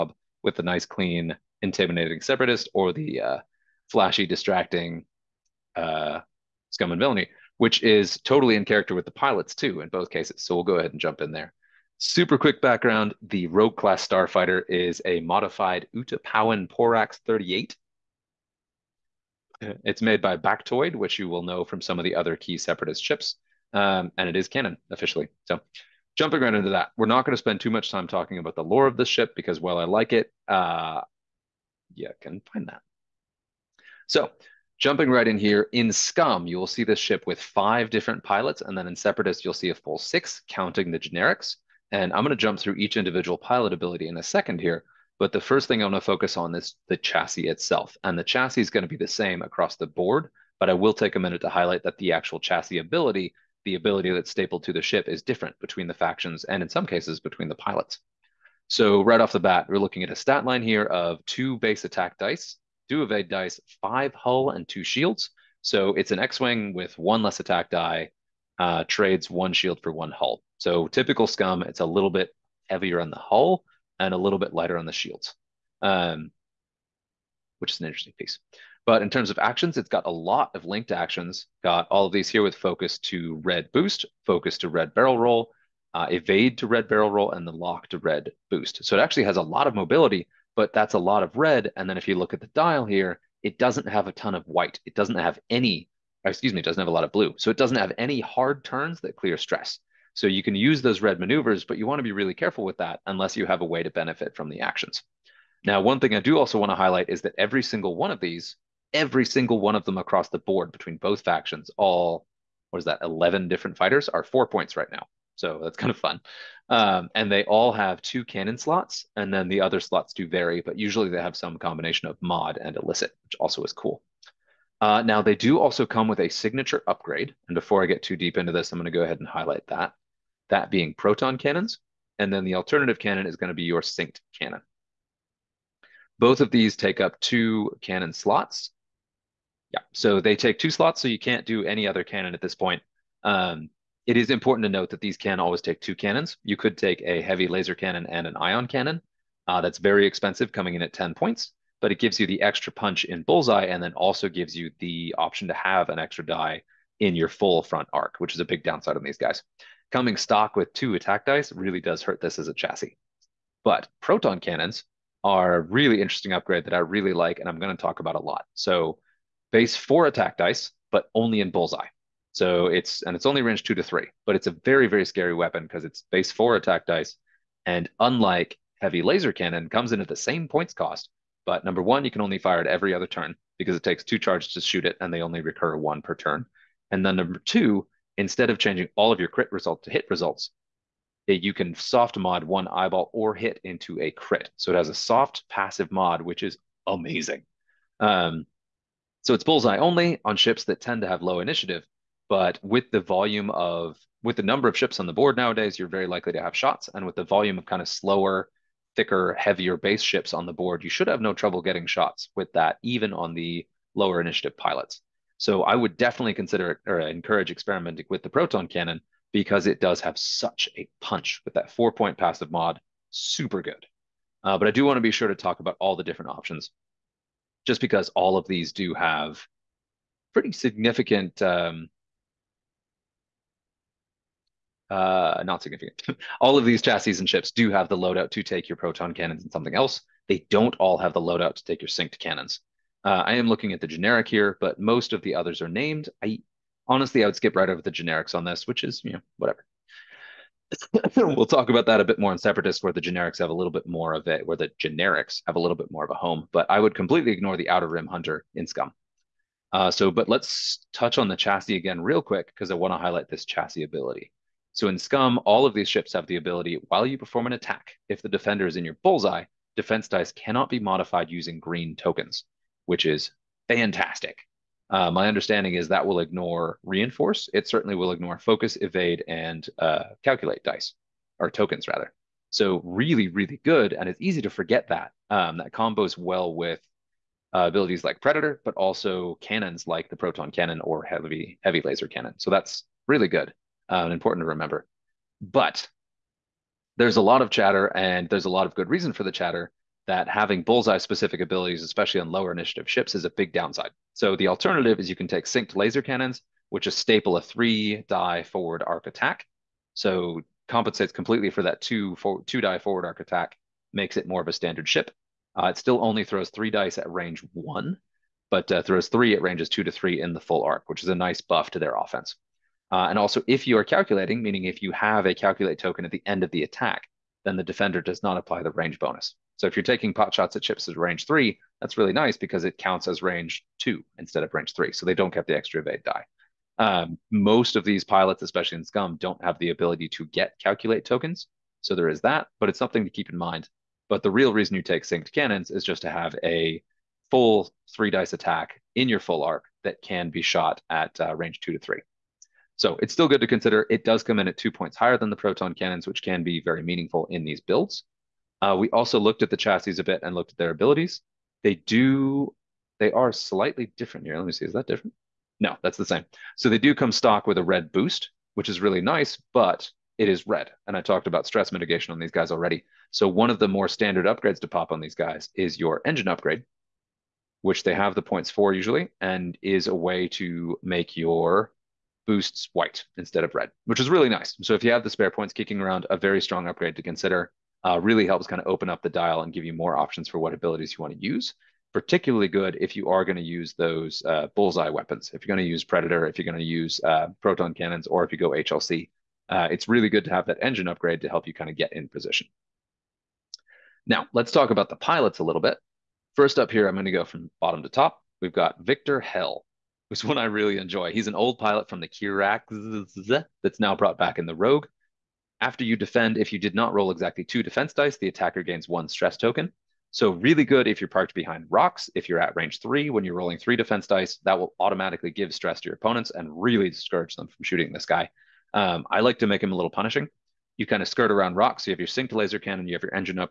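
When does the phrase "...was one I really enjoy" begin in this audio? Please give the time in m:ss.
6:50.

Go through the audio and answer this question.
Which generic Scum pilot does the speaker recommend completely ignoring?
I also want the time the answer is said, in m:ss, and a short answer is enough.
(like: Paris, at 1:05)
Outer Rim Hunter, at 4:17.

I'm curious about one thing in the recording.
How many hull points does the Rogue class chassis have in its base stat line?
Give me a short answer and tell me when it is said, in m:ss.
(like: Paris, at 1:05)
5, at 1:03.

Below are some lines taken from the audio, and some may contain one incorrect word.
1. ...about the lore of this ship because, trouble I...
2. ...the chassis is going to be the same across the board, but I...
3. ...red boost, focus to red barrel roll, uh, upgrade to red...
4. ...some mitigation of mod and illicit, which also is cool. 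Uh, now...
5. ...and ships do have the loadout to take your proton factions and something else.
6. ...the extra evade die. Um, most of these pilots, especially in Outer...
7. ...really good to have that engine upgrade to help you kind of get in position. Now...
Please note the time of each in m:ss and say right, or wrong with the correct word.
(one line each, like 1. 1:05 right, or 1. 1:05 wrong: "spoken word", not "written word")
1. 0:28 wrong: "while", not "trouble"
2. 0:48 right
3. 1:23 wrong: "evade", not "upgrade"
4. 2:01 wrong: "combination", not "mitigation"
5. 3:57 wrong: "cannons", not "factions"
6. 5:35 wrong: "Scum", not "Outer"
7. 6:39 right.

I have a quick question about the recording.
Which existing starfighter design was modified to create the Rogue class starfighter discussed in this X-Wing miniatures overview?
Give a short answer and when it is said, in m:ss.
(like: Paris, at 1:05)
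Utapauan Porax 38, at 0:15.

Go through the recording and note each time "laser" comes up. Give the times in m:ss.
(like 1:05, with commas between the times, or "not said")
2:27, 2:59, 4:51, 5:05, 7:12.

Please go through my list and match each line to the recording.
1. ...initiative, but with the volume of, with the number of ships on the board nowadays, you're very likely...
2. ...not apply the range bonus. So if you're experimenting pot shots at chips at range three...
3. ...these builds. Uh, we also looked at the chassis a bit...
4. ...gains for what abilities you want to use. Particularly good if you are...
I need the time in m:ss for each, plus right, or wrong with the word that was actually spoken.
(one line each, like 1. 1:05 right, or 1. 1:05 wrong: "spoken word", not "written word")
1. 3:21 right
2. 5:28 wrong: "taking", not "experimenting"
3. 5:57 right
4. 6:29 wrong: "options", not "gains".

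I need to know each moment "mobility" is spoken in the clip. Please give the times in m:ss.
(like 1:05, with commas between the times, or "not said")
1:29.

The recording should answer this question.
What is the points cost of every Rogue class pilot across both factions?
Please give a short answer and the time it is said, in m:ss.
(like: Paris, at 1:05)
4 points, at 1:54.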